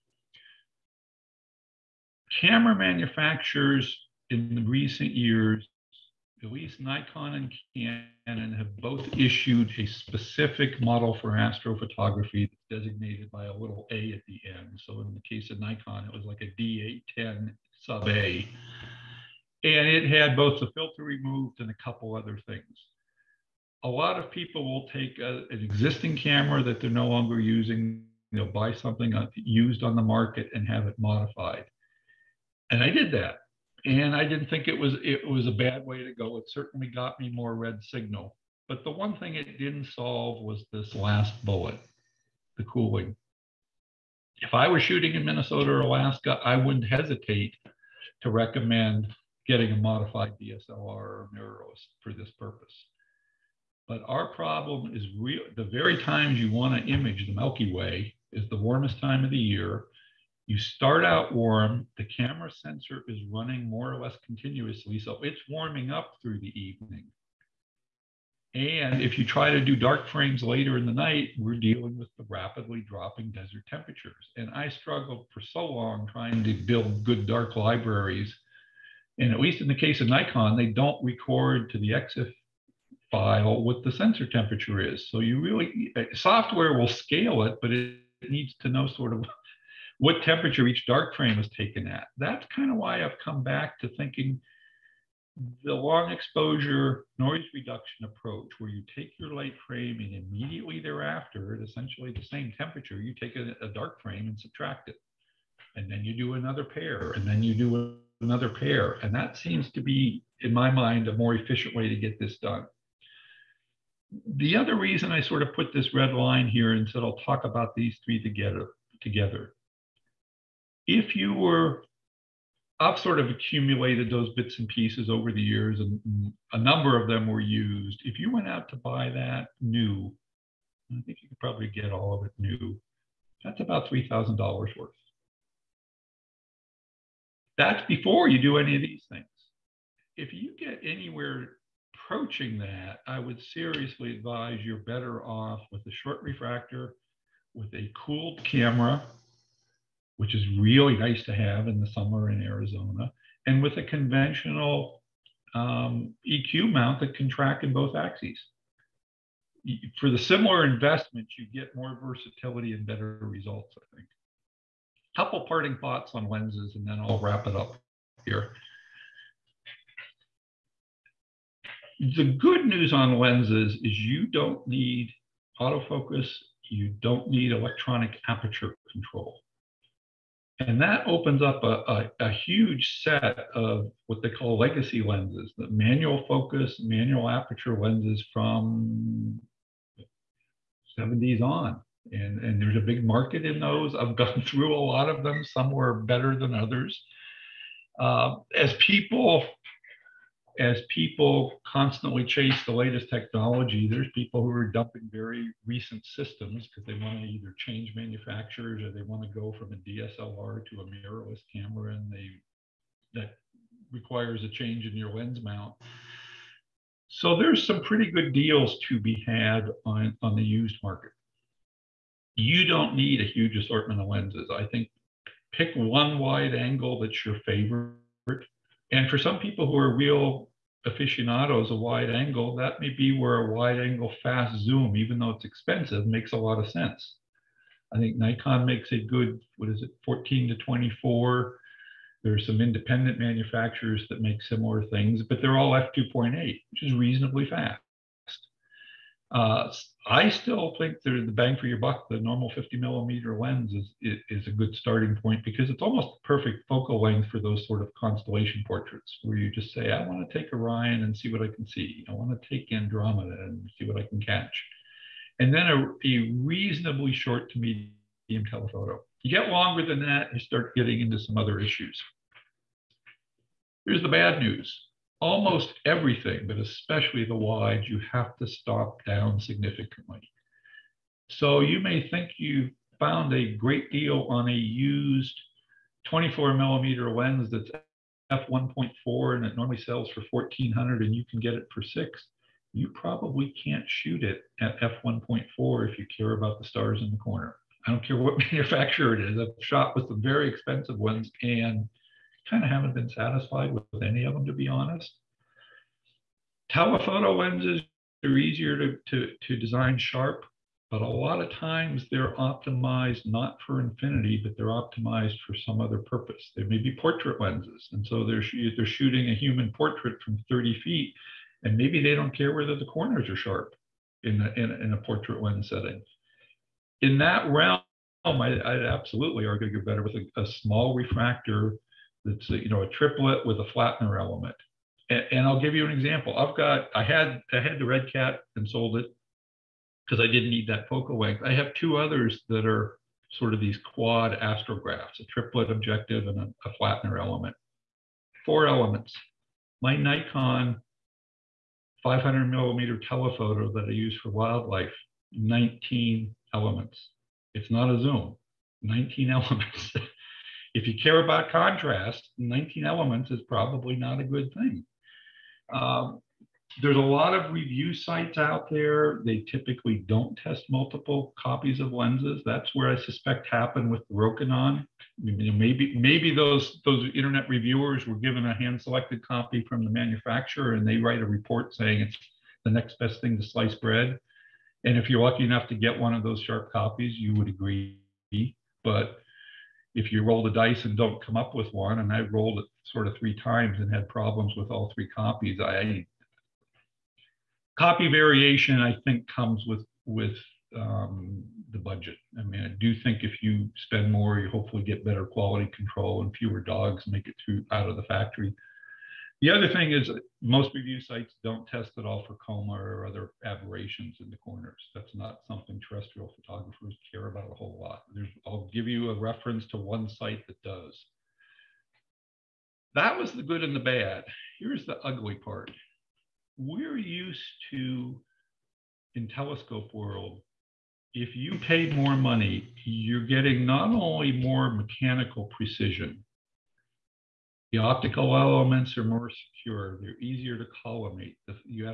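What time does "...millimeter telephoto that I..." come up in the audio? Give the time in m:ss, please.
5:52.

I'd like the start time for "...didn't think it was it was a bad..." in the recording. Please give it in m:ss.
0:34.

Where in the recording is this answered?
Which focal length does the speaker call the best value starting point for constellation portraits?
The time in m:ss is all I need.
4:12.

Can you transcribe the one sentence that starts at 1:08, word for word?
And if you try to do dark frames later in the night, we're dealing with the rapidly dropping desert temperatures.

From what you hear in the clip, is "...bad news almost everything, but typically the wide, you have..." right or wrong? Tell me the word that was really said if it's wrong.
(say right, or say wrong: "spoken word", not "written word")
wrong: "especially", not "typically".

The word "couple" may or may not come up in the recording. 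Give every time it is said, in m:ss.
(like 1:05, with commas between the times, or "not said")
0:21, 2:45.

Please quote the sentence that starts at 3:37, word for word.
So there's some pretty good deals to be had on, on the used market.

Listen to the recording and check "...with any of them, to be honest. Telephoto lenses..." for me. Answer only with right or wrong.
right.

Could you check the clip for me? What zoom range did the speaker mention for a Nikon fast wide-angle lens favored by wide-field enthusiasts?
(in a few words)
14 to 24.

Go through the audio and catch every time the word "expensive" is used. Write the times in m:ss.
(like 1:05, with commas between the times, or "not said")
3:55, 5:00.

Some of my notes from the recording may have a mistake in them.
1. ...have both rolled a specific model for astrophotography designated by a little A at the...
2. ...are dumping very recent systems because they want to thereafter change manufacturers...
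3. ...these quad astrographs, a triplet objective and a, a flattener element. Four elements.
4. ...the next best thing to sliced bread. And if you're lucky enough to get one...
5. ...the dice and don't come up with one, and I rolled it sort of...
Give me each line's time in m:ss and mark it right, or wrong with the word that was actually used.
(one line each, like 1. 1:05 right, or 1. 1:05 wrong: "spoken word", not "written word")
1. 0:08 wrong: "issued", not "rolled"
2. 3:24 wrong: "either", not "thereafter"
3. 5:43 right
4. 6:22 right
5. 6:30 right.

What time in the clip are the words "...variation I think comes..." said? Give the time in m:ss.
6:38.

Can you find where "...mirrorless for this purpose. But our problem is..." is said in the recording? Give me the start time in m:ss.
0:51.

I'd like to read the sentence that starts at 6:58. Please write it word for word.
There's, I'll give you a reference to one site that does.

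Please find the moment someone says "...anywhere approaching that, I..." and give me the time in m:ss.
2:20.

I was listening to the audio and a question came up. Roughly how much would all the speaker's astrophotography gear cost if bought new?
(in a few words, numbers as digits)
$3,000.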